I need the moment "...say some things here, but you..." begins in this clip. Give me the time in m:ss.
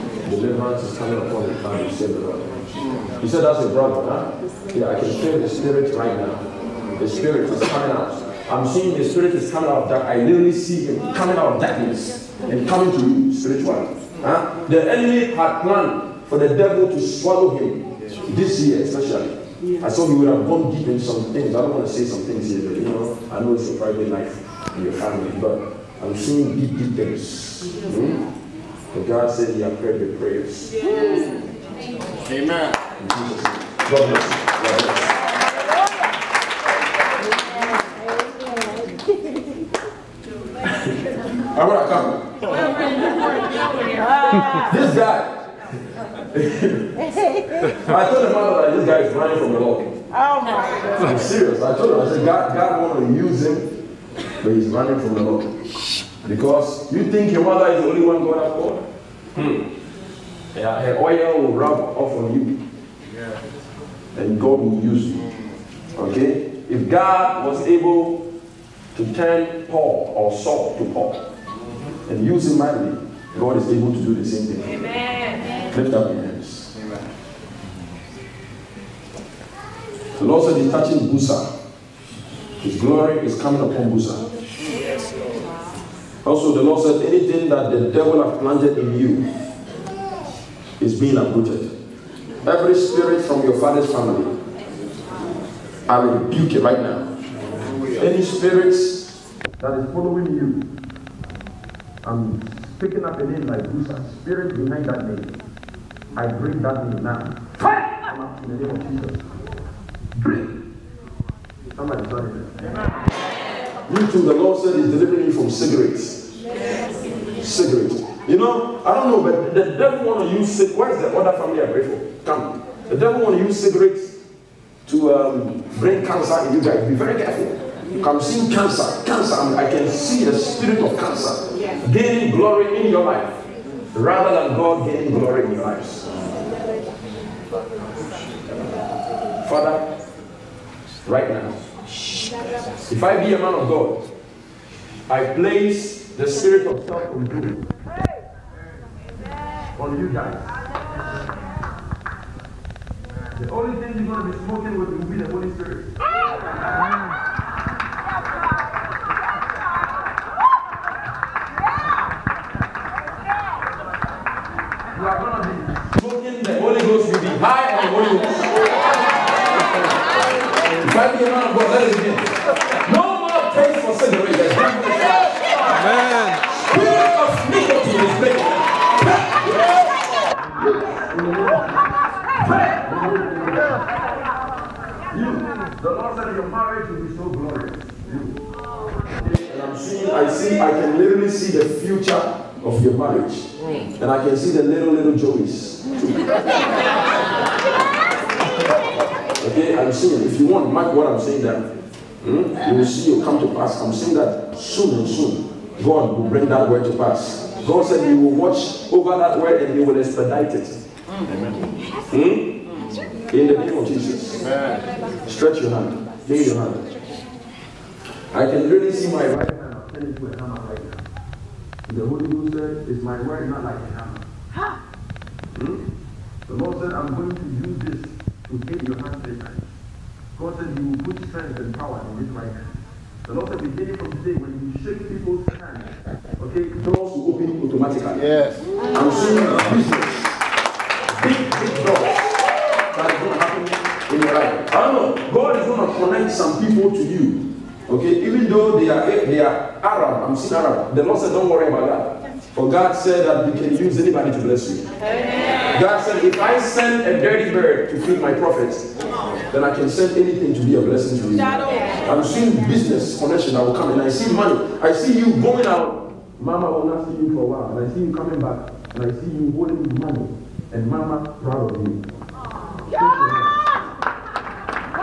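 0:21.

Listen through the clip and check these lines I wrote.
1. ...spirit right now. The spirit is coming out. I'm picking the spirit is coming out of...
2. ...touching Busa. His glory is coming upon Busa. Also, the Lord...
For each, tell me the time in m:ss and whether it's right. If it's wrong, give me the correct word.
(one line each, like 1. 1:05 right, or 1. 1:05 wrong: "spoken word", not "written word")
1. 0:05 wrong: "seeing", not "picking"
2. 1:20 right.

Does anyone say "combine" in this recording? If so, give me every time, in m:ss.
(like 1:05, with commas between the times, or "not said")
not said.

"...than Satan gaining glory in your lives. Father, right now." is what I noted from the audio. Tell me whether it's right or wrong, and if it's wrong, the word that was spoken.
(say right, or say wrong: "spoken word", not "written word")
wrong: "God", not "Satan".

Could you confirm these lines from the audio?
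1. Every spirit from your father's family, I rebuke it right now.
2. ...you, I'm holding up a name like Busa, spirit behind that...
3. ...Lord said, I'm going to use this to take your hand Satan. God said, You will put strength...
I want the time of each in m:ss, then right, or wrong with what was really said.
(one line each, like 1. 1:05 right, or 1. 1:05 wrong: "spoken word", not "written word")
1. 1:32 right
2. 1:40 wrong: "picking", not "holding"
3. 3:46 right.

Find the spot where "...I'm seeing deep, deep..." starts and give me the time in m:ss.
0:26.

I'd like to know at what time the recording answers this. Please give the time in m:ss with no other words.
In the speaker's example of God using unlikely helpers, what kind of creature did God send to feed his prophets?
4:17.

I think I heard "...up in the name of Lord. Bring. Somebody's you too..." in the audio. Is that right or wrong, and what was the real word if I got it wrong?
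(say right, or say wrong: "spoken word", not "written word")
wrong: "Jesus", not "Lord".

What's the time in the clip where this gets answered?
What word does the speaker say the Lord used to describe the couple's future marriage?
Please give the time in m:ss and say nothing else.
3:07.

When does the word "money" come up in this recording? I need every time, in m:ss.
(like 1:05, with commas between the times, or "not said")
4:24, 4:30.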